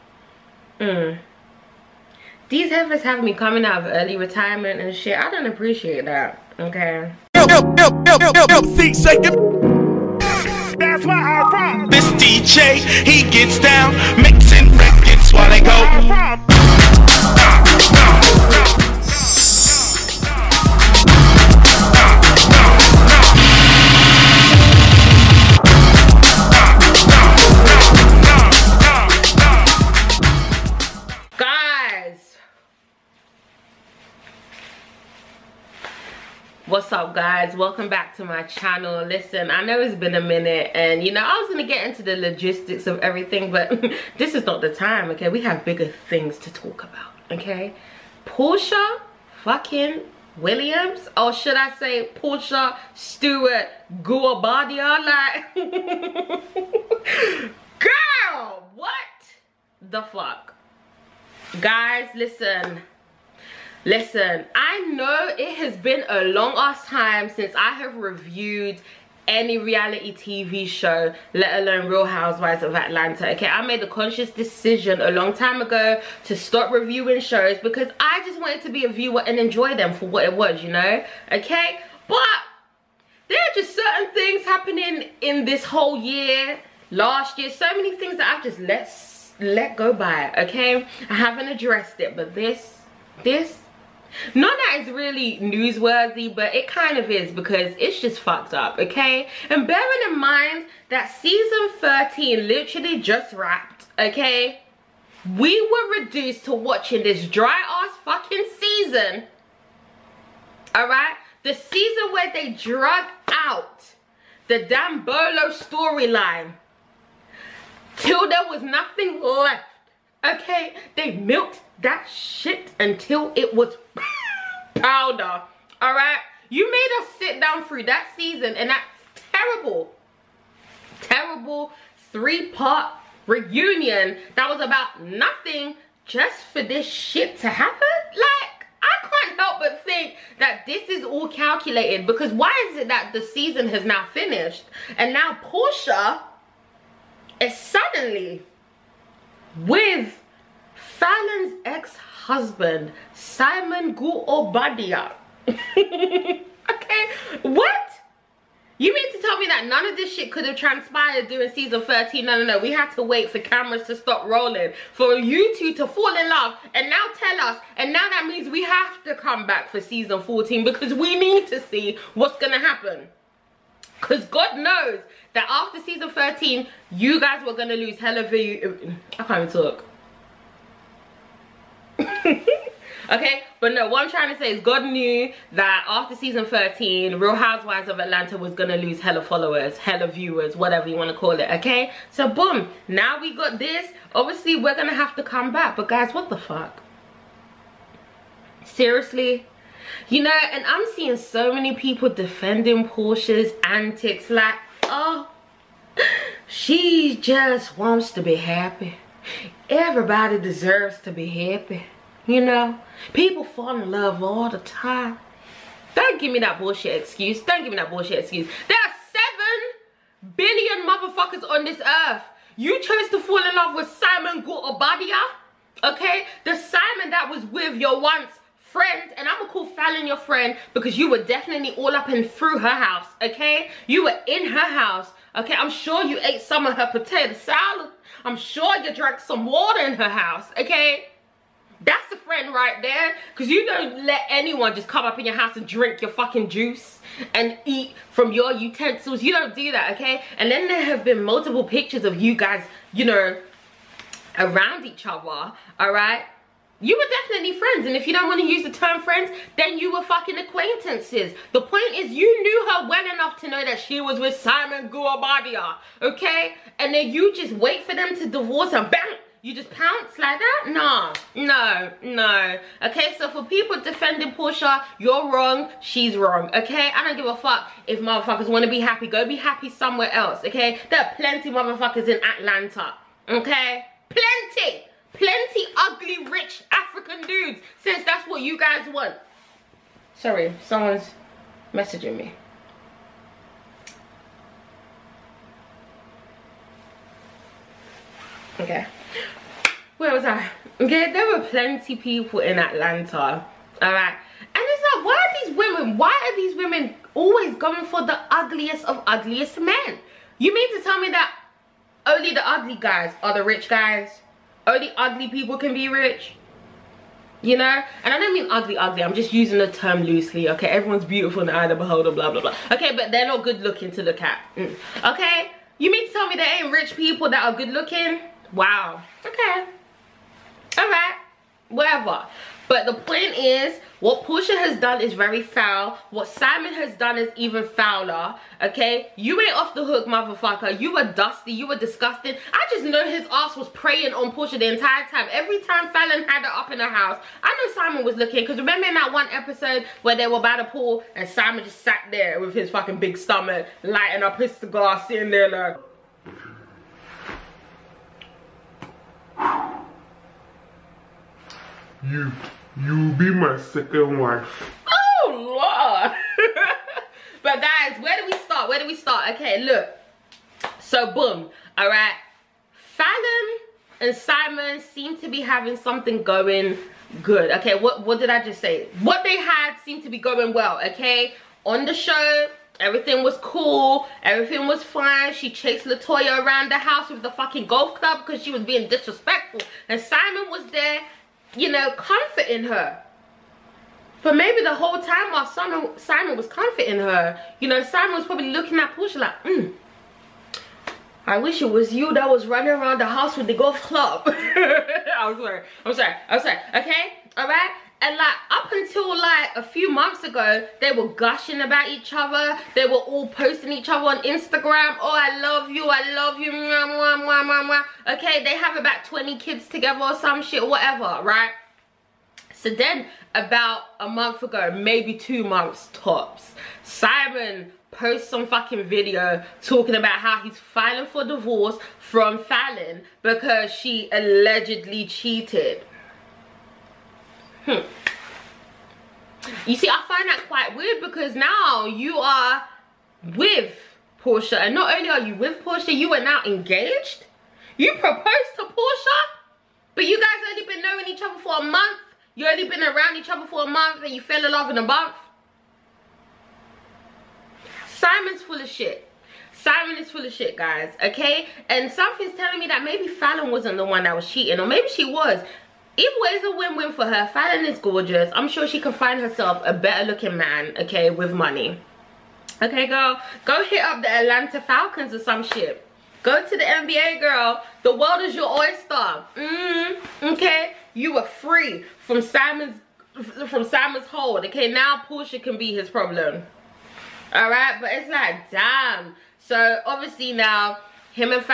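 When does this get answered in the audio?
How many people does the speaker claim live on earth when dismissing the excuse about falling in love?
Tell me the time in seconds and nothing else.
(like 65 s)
219 s.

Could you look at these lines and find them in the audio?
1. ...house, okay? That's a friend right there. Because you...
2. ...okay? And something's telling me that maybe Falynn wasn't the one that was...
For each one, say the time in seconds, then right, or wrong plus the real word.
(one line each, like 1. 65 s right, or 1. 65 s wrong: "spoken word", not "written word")
1. 240 s right
2. 461 s right.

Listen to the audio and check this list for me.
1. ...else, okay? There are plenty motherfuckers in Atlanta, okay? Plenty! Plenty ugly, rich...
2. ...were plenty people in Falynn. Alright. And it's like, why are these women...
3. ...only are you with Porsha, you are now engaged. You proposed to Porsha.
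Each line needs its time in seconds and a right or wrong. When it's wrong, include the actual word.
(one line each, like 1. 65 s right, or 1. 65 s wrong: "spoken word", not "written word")
1. 280 s right
2. 301 s wrong: "Atlanta", not "Falynn"
3. 444 s right.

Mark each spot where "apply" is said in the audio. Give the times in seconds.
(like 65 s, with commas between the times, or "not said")
not said.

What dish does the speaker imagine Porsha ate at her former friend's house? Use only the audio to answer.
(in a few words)
Potato salad.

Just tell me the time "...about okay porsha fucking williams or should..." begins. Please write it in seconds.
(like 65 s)
46 s.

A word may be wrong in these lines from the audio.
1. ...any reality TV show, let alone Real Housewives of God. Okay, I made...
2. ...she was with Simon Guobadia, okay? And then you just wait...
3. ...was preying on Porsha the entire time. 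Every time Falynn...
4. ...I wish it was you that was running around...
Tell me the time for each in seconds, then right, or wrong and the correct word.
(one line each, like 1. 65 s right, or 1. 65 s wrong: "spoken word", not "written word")
1. 69 s wrong: "Atlanta", not "God"
2. 263 s right
3. 343 s right
4. 401 s right.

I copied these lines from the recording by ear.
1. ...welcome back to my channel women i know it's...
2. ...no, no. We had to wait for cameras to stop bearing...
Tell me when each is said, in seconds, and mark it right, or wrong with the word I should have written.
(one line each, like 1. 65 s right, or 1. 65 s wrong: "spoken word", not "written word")
1. 37 s wrong: "listen", not "women"
2. 162 s wrong: "rolling", not "bearing".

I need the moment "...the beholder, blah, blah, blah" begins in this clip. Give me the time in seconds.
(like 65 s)
321 s.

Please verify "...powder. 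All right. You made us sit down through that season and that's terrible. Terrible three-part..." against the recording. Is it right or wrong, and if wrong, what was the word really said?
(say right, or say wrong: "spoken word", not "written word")
right.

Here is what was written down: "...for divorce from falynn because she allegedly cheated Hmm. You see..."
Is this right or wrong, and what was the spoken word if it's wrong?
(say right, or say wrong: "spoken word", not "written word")
right.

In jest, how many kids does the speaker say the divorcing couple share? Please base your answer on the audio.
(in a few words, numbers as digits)
20.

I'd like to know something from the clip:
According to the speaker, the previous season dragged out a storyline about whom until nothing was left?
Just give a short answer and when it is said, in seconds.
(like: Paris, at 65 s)
Bolo, at 115 s.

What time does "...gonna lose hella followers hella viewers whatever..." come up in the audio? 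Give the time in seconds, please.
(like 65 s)
188 s.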